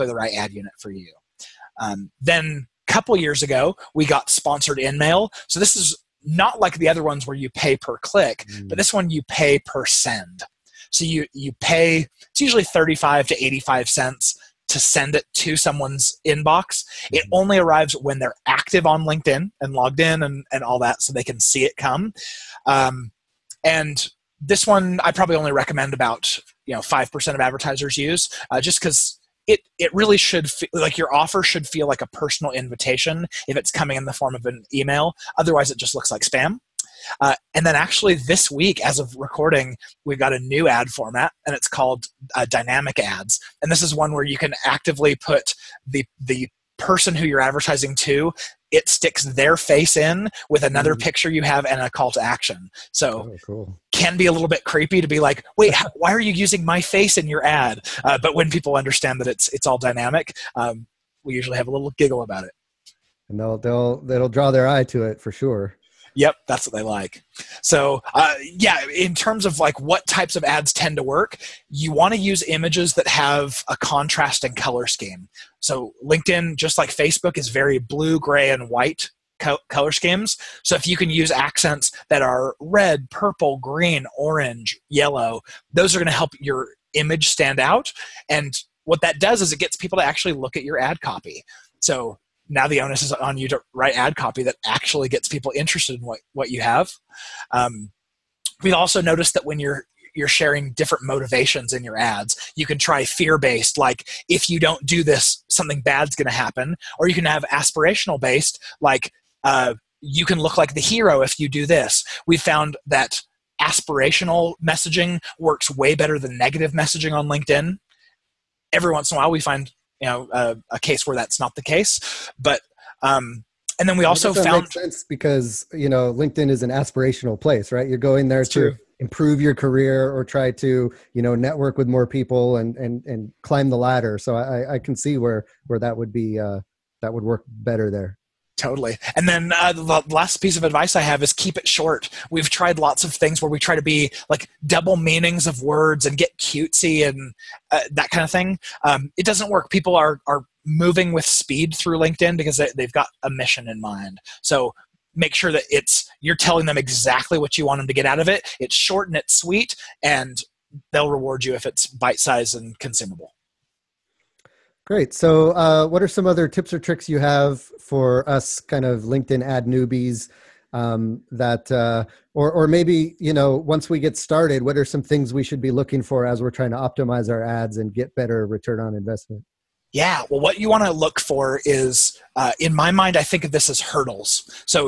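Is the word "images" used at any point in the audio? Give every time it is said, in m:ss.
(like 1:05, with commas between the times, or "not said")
1:12, 1:26.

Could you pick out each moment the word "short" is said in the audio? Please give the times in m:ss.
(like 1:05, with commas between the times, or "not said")
2:21, 2:38.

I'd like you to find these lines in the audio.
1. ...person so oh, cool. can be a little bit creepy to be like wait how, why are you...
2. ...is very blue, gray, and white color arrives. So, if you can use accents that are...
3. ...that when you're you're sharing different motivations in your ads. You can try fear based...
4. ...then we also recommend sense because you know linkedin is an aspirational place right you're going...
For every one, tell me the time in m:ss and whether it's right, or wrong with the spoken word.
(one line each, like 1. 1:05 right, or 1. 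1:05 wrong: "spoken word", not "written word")
1. 0:52 wrong: "action", not "person"
2. 1:17 wrong: "schemes", not "arrives"
3. 1:39 right
4. 2:03 wrong: "found", not "recommend".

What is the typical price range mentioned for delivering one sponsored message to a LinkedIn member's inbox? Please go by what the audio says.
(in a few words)
35 to 85 cents.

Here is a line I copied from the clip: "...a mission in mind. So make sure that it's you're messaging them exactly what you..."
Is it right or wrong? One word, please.
wrong.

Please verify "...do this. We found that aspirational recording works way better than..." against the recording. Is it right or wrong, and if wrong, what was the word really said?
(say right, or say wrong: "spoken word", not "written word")
wrong: "messaging", not "recording".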